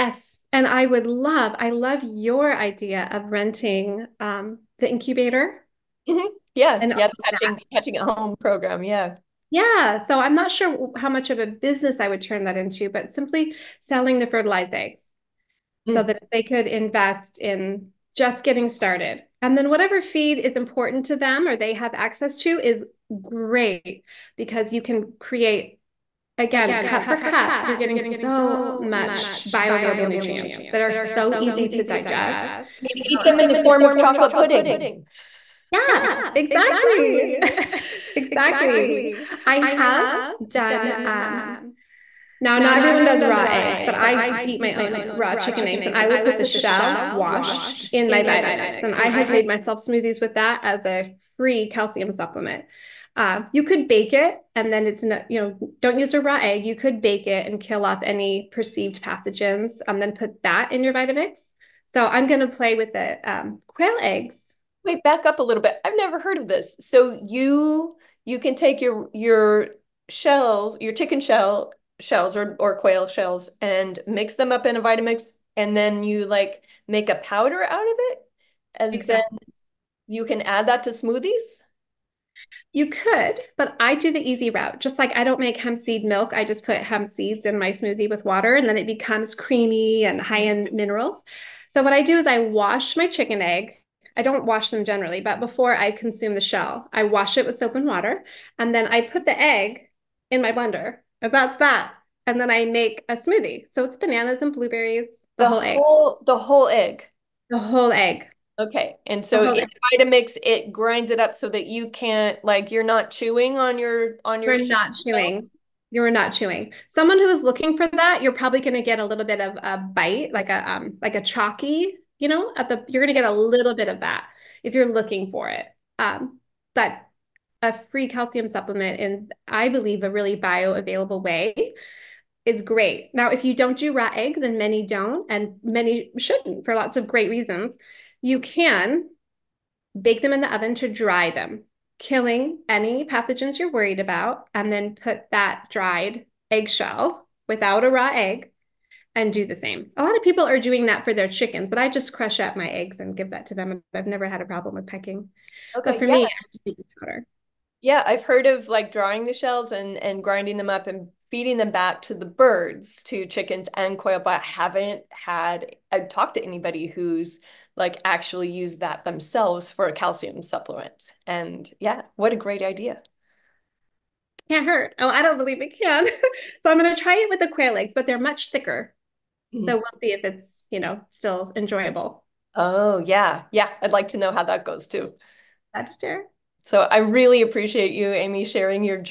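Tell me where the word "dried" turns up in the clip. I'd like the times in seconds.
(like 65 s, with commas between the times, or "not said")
145 s.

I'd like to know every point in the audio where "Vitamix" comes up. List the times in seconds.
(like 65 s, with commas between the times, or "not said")
48 s, 60 s, 74 s, 109 s.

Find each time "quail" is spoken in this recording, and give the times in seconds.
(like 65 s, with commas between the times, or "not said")
63 s, 72 s, 163 s, 177 s.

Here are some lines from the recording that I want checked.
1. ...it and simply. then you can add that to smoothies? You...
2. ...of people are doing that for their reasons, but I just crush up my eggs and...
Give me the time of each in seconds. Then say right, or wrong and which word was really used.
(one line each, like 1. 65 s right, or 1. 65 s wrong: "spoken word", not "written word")
1. 77 s wrong: "exactly", not "simply"
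2. 150 s wrong: "chickens", not "reasons".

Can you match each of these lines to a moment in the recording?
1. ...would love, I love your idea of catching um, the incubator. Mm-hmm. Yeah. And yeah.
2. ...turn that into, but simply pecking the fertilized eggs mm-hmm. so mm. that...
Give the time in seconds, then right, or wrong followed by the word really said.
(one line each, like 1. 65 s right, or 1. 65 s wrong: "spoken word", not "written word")
1. 0 s wrong: "renting", not "catching"
2. 12 s wrong: "selling", not "pecking".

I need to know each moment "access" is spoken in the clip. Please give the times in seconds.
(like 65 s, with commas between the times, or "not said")
21 s.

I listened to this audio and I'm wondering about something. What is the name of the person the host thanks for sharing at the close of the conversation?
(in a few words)
Amy.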